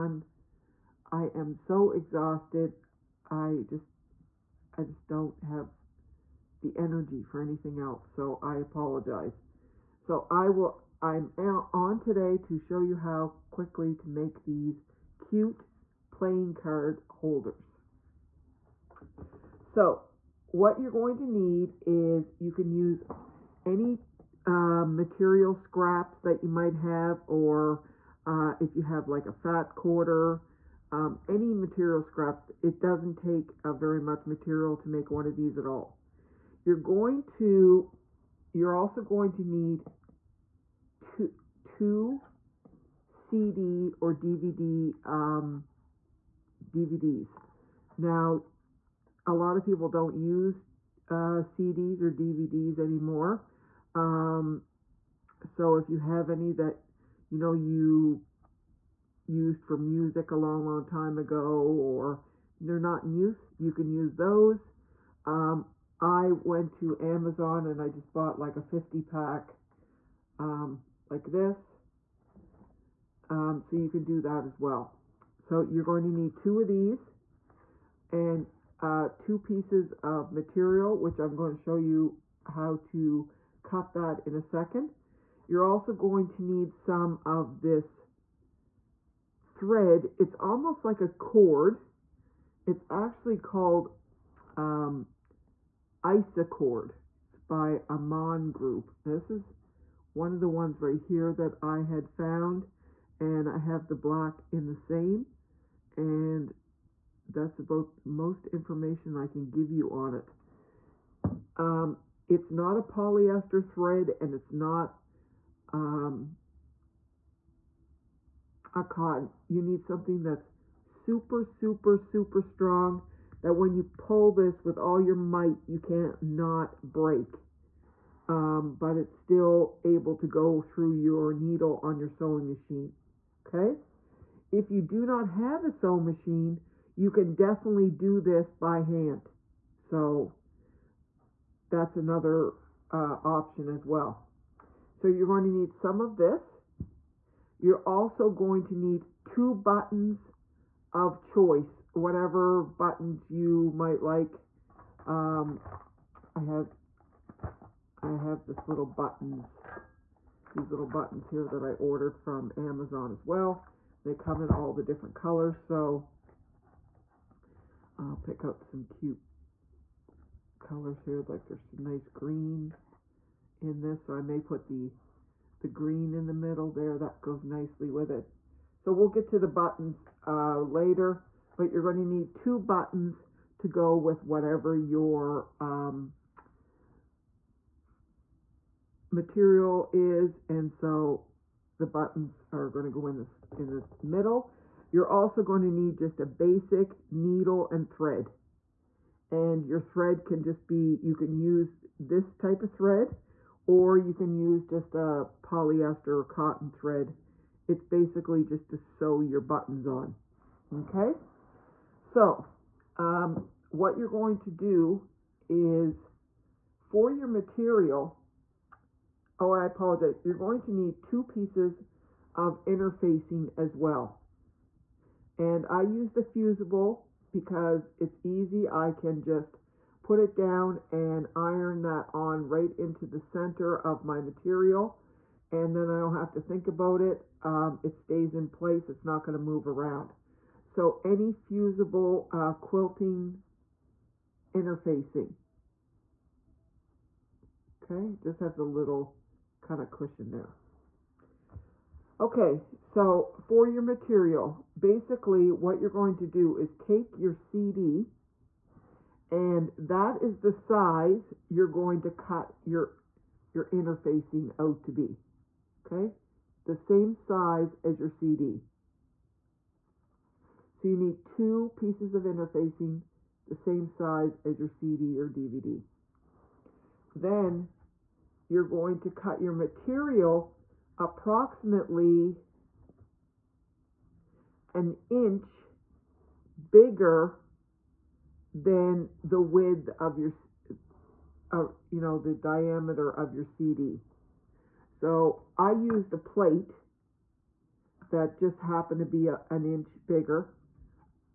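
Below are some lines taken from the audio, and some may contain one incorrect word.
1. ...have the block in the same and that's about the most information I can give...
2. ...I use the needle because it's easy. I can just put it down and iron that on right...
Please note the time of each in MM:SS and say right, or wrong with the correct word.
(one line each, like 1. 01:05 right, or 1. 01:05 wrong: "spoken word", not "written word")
1. 01:43 right
2. 03:45 wrong: "fusible", not "needle".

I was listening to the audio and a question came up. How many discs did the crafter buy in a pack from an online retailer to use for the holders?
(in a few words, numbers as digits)
50.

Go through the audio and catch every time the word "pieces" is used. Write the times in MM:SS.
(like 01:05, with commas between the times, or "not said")
01:19, 03:41, 04:31.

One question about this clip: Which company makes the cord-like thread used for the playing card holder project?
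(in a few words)
Amann Group.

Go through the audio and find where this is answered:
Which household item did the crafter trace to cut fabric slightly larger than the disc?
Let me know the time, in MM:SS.
04:56.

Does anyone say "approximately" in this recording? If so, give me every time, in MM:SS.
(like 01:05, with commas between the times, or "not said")
04:40.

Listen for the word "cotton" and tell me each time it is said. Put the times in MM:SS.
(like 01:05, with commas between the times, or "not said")
01:58, 03:26.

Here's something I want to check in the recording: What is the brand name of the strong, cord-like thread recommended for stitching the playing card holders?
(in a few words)
Isacord.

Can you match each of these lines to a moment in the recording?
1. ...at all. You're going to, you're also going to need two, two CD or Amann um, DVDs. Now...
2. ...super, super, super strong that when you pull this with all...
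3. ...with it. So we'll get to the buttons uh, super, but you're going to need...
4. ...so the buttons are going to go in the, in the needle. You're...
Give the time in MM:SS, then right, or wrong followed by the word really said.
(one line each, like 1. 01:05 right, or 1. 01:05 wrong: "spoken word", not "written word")
1. 00:35 wrong: "DVD", not "Amann"
2. 02:00 right
3. 02:57 wrong: "later", not "super"
4. 03:10 wrong: "middle", not "needle".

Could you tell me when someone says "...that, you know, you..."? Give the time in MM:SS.
00:56.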